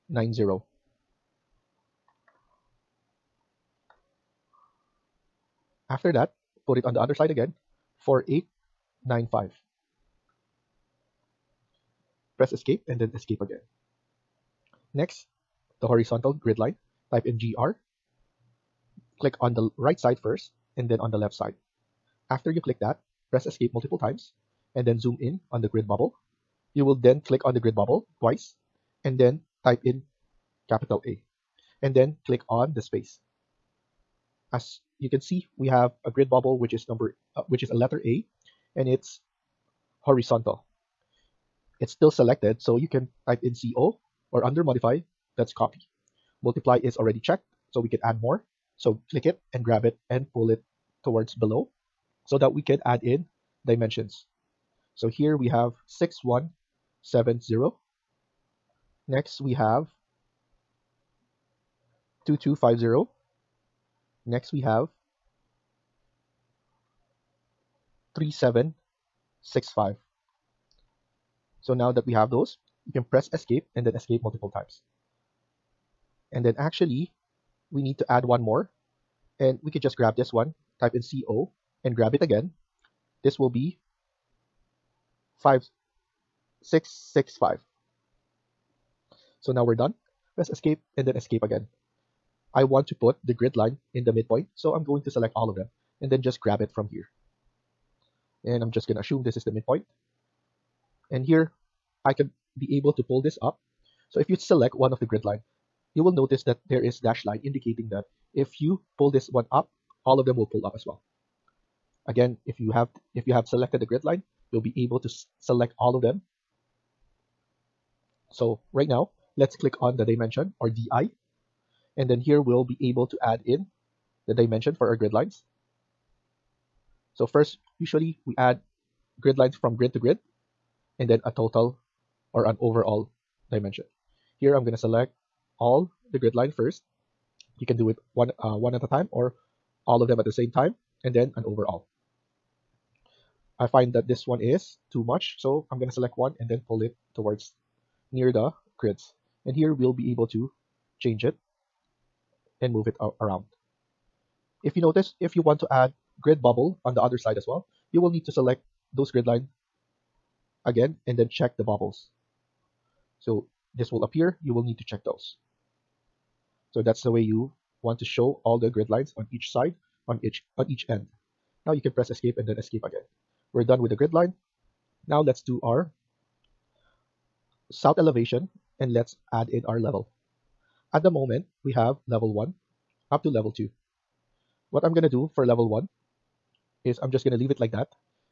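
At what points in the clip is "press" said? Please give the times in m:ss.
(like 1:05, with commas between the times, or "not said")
0:12, 0:23, 1:13, 1:30, 2:51.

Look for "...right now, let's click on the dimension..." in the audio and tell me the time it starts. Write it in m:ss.
1:58.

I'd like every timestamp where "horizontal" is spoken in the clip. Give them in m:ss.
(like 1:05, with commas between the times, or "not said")
0:15, 0:40.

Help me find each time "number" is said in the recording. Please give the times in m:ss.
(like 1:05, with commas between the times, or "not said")
0:36.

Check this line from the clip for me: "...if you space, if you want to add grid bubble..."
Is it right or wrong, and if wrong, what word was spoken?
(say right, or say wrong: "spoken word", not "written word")
wrong: "notice", not "space".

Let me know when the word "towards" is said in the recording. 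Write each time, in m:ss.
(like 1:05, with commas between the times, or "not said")
0:51, 2:27.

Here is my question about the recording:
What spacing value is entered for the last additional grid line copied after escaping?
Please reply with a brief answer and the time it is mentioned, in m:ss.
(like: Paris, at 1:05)
5665, at 1:25.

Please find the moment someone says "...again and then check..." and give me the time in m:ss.
2:40.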